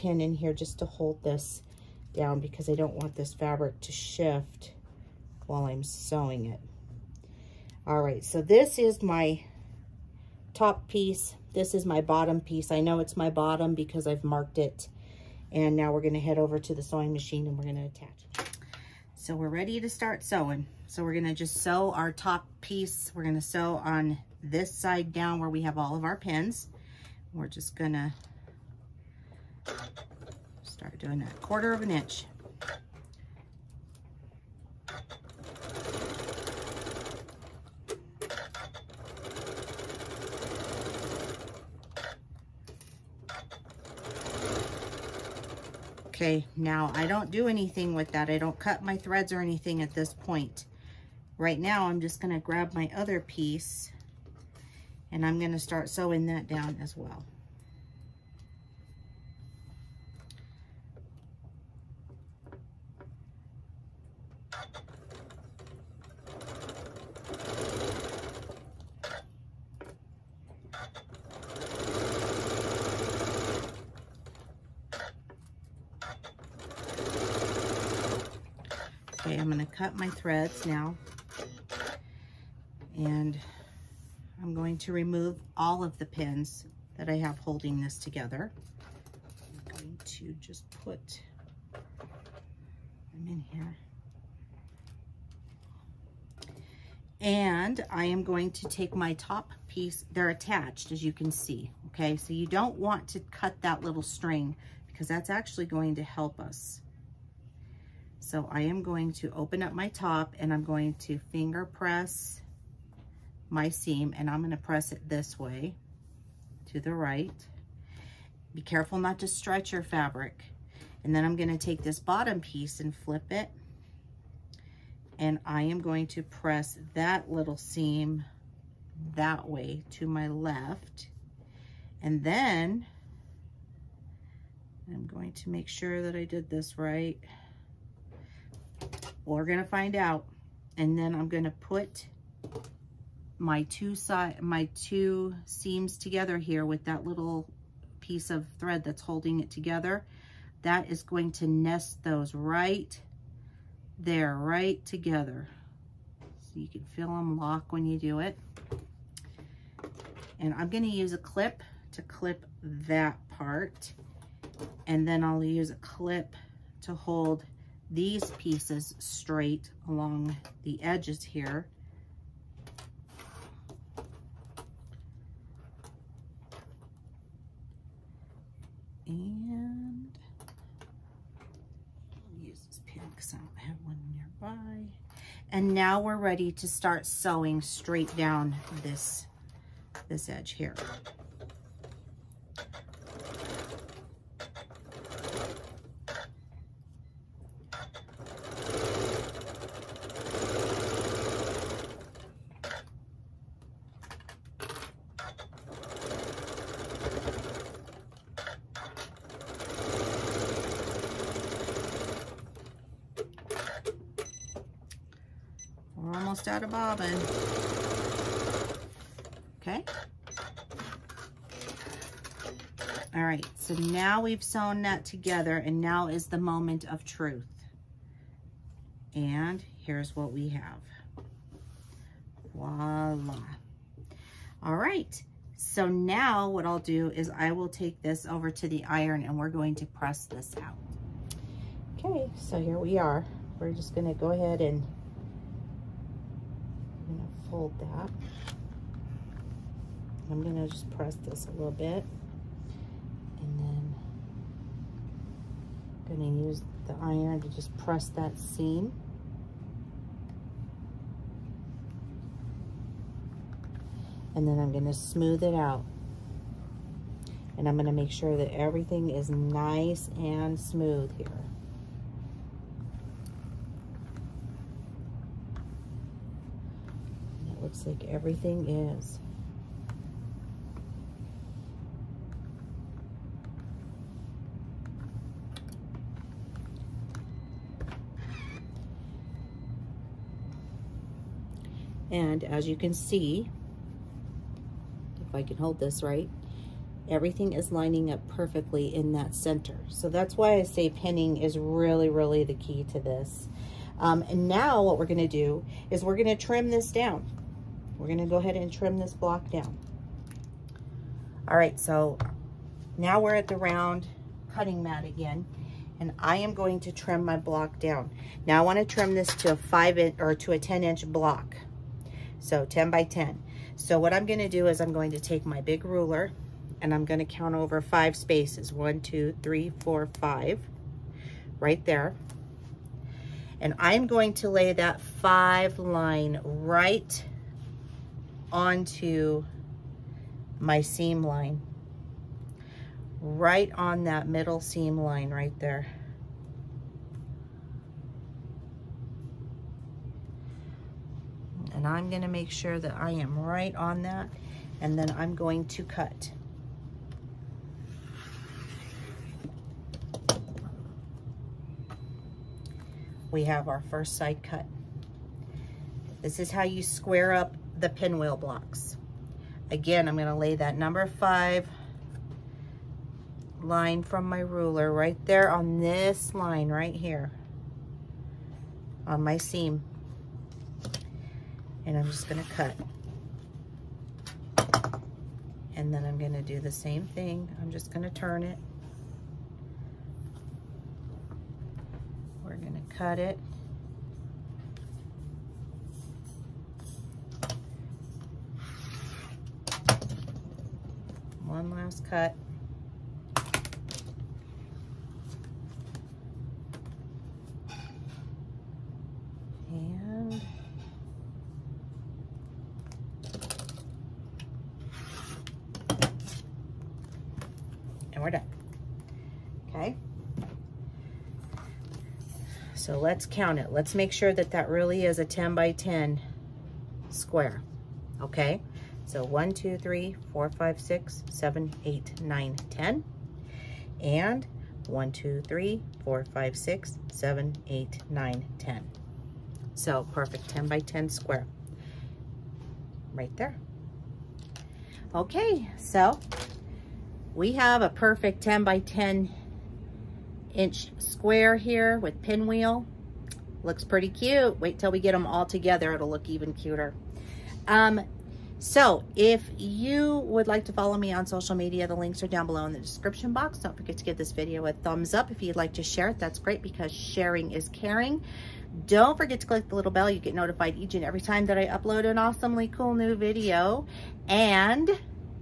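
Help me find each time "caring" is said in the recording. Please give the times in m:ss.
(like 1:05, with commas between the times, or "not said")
7:47.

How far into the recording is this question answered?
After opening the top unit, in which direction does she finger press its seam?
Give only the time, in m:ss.
1:56.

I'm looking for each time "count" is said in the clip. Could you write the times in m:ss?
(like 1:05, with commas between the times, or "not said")
5:27, 7:03.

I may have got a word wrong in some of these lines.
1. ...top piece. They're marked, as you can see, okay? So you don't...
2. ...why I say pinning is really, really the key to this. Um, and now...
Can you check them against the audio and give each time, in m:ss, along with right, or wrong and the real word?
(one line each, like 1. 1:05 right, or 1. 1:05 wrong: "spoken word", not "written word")
1. 1:39 wrong: "attached", not "marked"
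2. 5:00 right.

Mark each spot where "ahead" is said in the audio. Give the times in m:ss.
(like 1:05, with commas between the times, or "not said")
4:04, 5:08.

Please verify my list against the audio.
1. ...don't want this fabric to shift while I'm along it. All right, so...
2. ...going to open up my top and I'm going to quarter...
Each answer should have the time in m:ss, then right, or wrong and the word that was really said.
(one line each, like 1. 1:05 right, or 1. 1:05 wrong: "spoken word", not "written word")
1. 0:02 wrong: "sewing", not "along"
2. 1:48 wrong: "finger", not "quarter".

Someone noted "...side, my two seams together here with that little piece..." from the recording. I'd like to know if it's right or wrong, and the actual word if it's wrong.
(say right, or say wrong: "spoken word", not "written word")
right.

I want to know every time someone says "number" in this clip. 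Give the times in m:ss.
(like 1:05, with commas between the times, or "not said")
6:10.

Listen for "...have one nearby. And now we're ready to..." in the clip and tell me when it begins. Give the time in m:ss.
3:03.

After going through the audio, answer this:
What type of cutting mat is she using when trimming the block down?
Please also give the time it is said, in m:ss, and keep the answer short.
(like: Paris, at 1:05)
round cutting mat, at 5:13.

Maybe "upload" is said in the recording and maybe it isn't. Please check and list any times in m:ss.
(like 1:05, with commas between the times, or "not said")
7:51.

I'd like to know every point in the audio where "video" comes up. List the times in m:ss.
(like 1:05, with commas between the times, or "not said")
7:44, 7:53.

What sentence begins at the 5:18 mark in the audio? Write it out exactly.
Now I wanna trim this to a five inch or to a 10 inch block.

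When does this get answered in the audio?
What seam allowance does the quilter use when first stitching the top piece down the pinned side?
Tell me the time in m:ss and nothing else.
0:31.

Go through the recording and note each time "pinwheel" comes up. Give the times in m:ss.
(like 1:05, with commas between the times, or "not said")
6:07, 7:32.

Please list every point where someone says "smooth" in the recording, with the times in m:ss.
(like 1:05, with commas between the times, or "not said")
4:24, 4:30.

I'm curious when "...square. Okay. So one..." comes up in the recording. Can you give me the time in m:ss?
7:07.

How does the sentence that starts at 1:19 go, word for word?
Okay, I'm going to cut my threads now.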